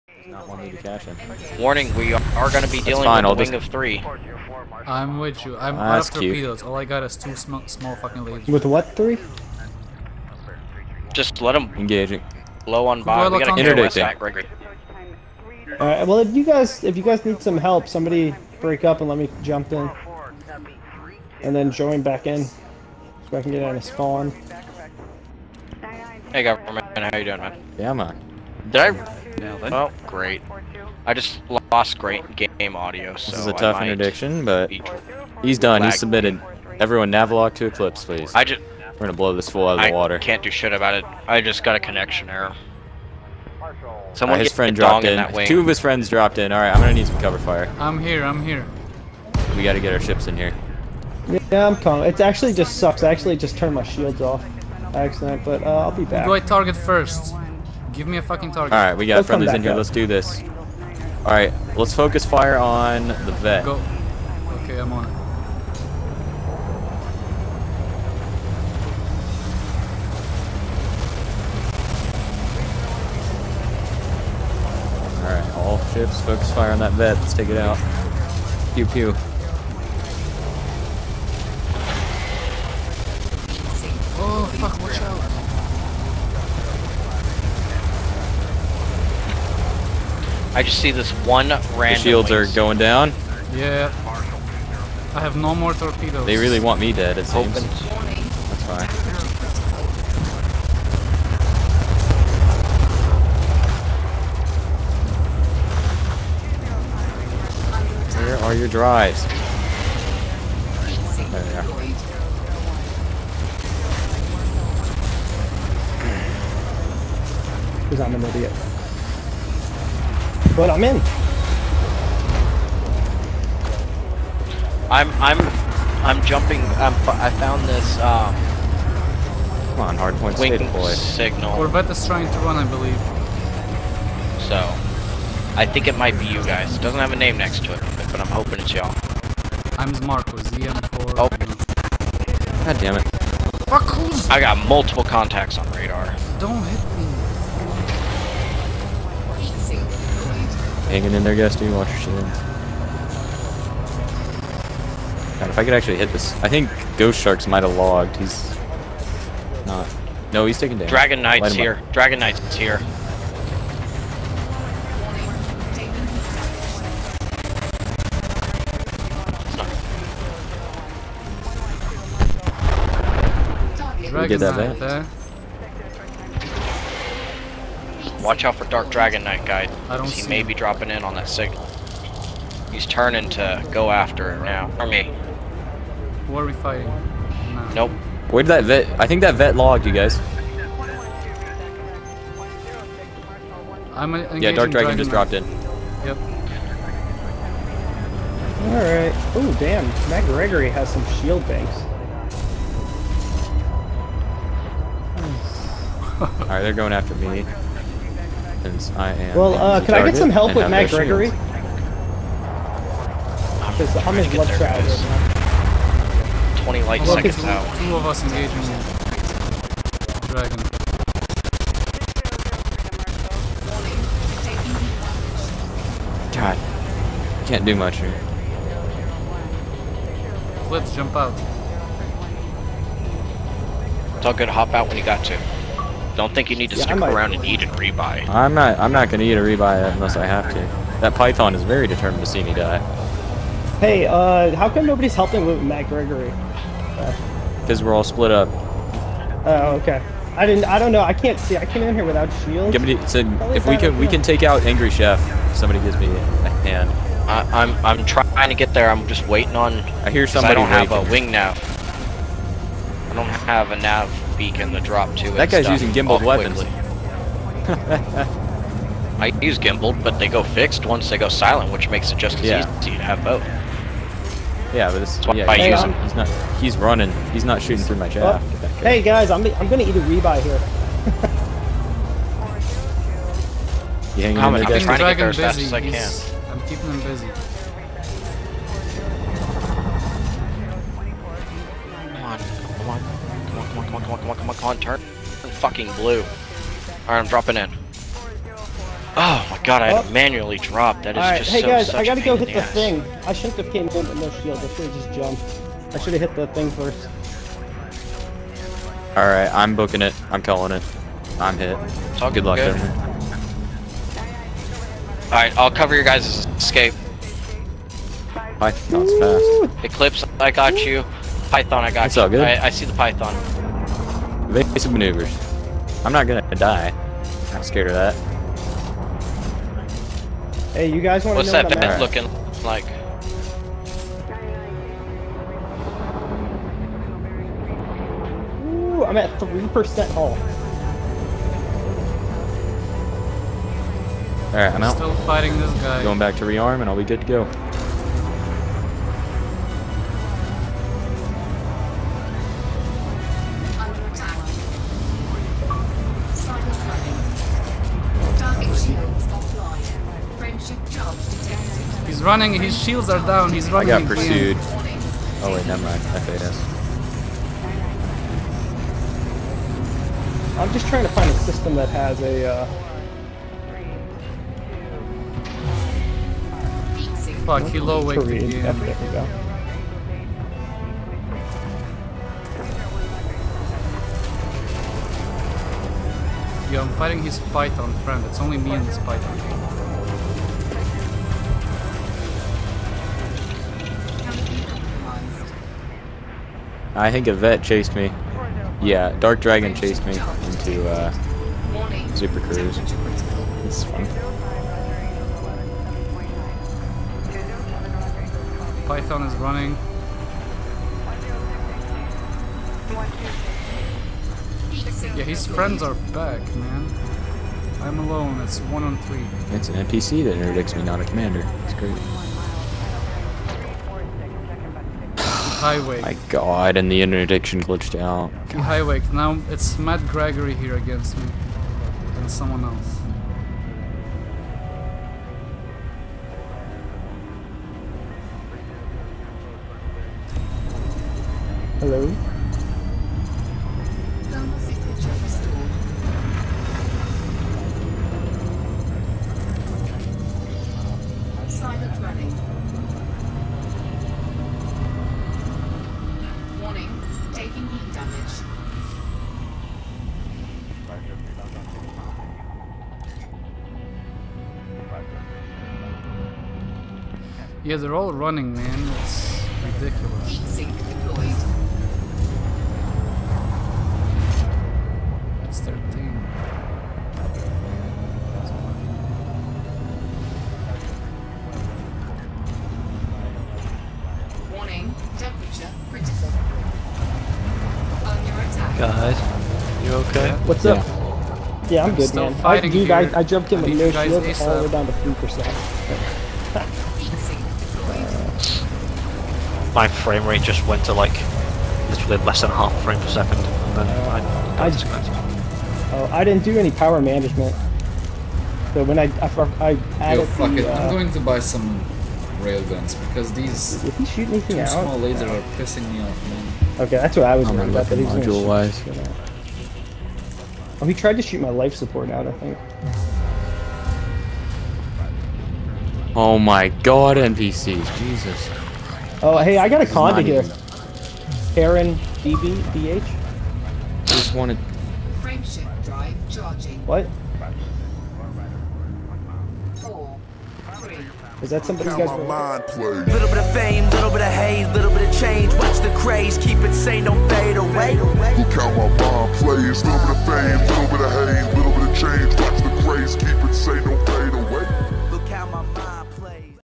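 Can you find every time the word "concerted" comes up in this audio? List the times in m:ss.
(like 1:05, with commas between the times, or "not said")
not said.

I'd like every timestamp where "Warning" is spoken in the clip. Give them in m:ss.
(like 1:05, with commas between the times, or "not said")
0:01, 8:04.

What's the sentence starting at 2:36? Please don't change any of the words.
I think Ghost Sharks might have logged.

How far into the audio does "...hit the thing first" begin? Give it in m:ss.
5:06.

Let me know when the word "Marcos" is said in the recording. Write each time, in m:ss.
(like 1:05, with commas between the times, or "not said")
2:20.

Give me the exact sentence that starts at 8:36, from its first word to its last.
Okay, that's what I was worried about.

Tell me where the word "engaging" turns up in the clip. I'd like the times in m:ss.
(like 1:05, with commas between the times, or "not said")
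0:11, 3:38.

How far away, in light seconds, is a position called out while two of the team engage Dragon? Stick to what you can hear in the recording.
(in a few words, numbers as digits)
20 light seconds.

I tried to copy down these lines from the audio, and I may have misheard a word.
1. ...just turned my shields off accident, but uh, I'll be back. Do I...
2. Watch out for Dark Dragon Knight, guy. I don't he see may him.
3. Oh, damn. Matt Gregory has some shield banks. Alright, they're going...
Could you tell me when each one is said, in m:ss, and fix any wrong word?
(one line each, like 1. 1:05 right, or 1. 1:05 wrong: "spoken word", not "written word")
1. 0:53 right
2. 2:58 right
3. 3:19 right.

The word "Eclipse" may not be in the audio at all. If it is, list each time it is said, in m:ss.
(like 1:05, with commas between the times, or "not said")
0:37, 5:19.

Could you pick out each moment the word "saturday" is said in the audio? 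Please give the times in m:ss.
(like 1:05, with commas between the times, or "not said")
not said.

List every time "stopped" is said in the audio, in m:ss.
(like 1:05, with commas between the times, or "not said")
not said.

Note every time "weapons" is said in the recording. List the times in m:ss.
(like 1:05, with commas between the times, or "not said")
4:26.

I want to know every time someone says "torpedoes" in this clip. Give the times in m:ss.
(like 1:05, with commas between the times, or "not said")
0:06, 1:35.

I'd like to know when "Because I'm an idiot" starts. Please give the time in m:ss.
1:57.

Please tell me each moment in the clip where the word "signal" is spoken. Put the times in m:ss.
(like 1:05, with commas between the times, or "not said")
2:10, 3:01.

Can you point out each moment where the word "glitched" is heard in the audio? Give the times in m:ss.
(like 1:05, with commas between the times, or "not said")
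7:07.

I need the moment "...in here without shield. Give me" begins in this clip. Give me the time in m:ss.
4:11.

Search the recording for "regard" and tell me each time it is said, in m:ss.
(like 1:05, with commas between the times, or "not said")
not said.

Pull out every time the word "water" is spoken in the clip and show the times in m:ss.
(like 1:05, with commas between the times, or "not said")
0:39.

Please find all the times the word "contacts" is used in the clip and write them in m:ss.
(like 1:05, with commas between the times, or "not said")
2:25.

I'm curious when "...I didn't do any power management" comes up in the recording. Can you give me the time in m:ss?
8:26.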